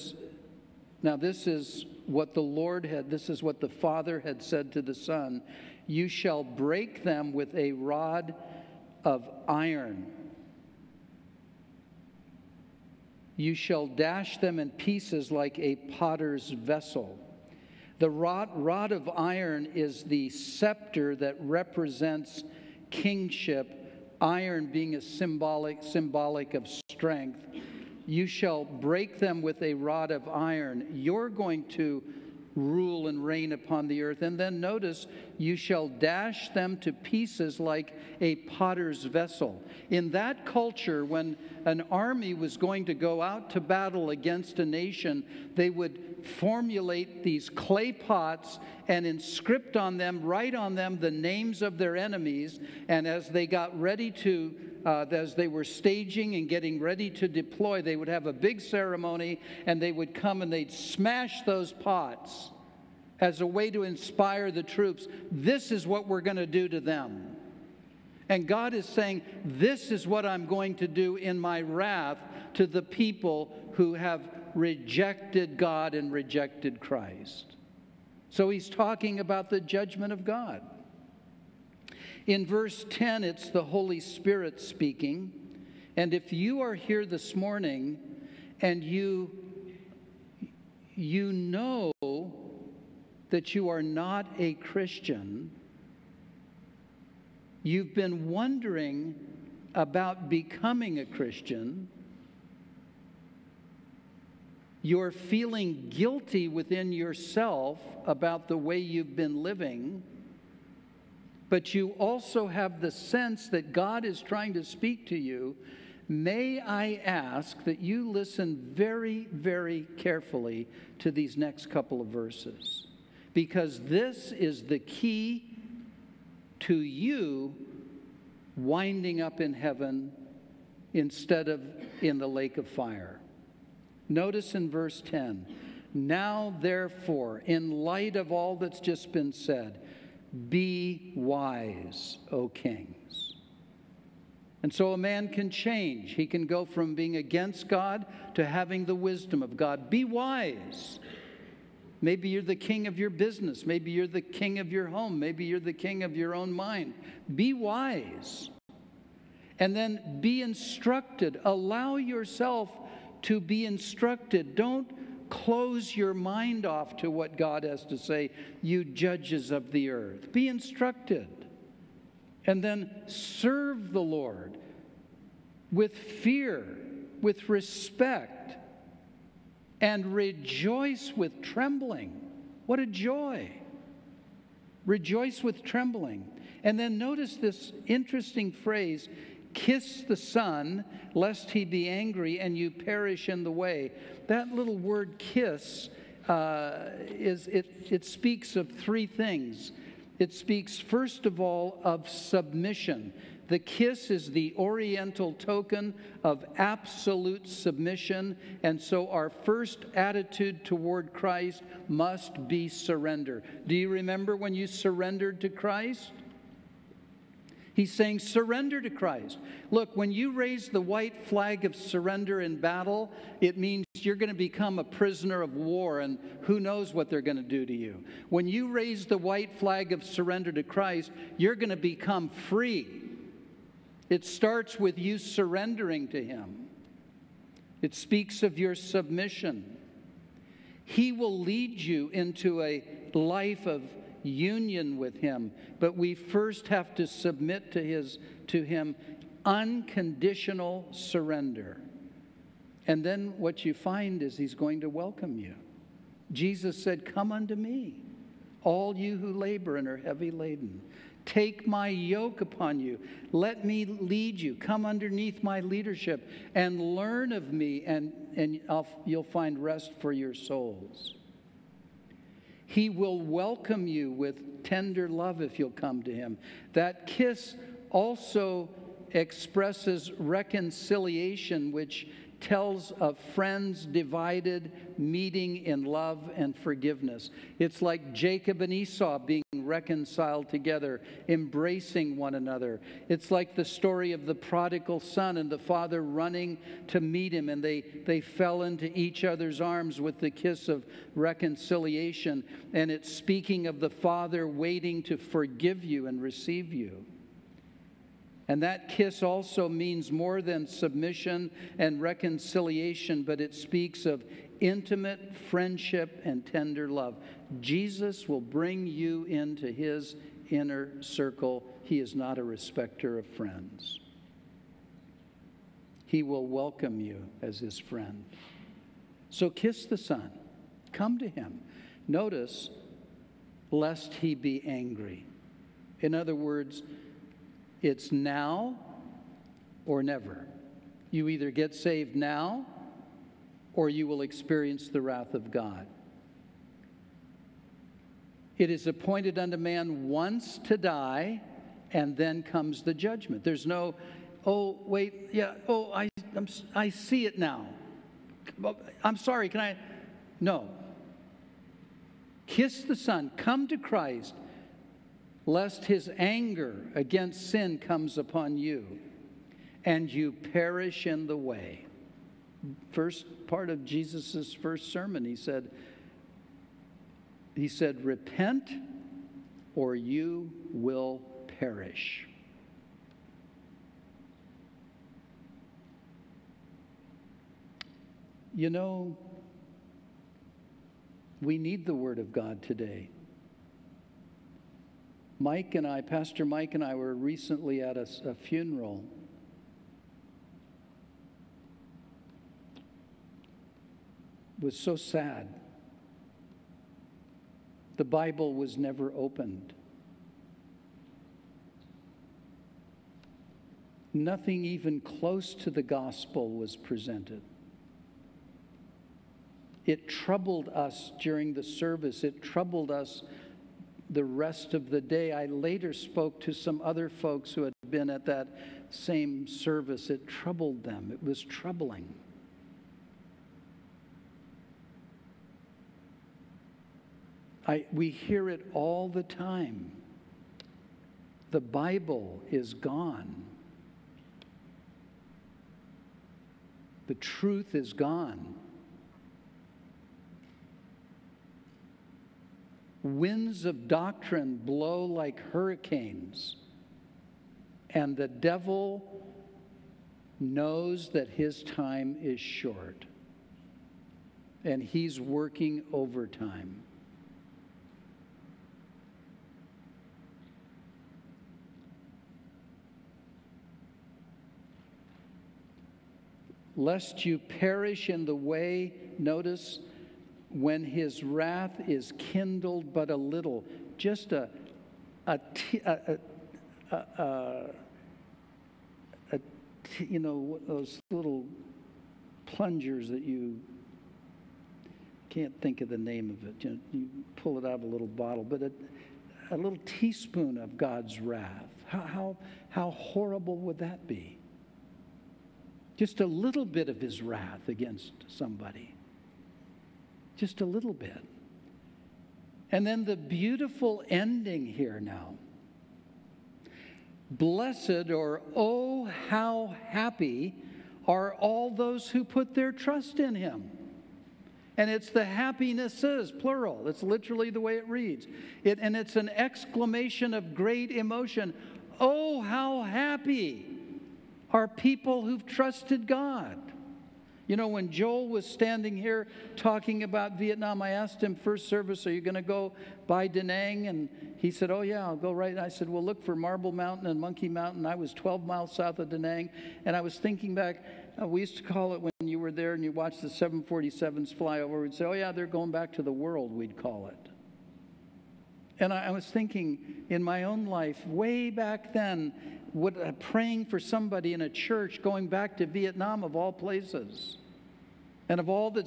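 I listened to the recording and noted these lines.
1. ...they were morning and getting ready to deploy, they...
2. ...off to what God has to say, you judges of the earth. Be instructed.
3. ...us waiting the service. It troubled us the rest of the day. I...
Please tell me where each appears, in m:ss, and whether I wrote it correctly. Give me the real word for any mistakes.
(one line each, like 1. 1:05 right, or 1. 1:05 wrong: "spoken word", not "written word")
1. 0:55 wrong: "staging", not "morning"
2. 2:46 right
3. 7:00 wrong: "during", not "waiting".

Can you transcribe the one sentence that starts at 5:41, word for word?
You either get saved now or you will experience the wrath of God.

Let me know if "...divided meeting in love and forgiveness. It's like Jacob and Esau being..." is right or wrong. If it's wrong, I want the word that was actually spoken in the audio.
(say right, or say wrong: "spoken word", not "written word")
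right.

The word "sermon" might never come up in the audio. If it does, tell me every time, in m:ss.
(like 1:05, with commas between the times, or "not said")
6:14.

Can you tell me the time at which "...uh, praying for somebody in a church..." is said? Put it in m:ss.
9:22.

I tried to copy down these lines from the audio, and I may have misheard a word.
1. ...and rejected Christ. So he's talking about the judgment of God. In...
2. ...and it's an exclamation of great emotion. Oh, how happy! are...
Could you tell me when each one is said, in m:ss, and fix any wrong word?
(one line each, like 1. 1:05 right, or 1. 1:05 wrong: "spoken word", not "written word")
1. 1:15 right
2. 8:48 right.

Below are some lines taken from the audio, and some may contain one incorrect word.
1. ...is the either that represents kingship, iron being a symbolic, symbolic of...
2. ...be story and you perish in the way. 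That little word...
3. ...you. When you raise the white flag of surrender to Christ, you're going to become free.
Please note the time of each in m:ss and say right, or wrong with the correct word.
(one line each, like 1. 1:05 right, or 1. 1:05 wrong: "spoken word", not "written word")
1. 0:19 wrong: "scepter", not "either"
2. 3:11 wrong: "angry", not "story"
3. 3:47 right.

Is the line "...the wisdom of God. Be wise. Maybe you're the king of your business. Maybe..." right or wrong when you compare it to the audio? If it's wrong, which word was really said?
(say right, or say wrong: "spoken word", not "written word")
right.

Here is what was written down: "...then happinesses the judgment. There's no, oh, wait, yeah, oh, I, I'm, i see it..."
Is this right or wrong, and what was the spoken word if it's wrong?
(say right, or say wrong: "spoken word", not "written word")
wrong: "comes", not "happinesses".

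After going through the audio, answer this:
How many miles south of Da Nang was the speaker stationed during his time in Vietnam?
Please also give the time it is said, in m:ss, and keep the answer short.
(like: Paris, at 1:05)
12, at 9:08.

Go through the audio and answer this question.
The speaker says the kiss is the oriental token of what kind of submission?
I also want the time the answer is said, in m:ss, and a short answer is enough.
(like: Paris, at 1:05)
Absolute submission, at 3:26.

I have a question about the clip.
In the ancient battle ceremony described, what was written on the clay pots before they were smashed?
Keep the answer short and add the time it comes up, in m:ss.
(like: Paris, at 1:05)
Names of their enemies, at 0:51.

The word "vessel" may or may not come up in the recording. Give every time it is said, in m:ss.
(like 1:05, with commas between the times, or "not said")
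0:16, 0:39.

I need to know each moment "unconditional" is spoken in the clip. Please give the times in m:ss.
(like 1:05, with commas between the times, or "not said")
4:09.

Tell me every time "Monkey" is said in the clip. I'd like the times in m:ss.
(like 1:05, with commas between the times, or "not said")
9:07.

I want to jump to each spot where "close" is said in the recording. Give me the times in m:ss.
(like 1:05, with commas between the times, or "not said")
2:45, 6:54.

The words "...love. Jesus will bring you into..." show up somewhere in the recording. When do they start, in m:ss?
5:16.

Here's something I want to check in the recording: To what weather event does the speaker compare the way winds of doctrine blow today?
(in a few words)
Hurricanes.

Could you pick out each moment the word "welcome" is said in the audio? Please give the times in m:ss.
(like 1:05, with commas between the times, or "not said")
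4:14, 4:33, 5:26.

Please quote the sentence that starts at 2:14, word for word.
Notice in verse 10 Now, therefore, in light of all that's just been said, be wise, O kings.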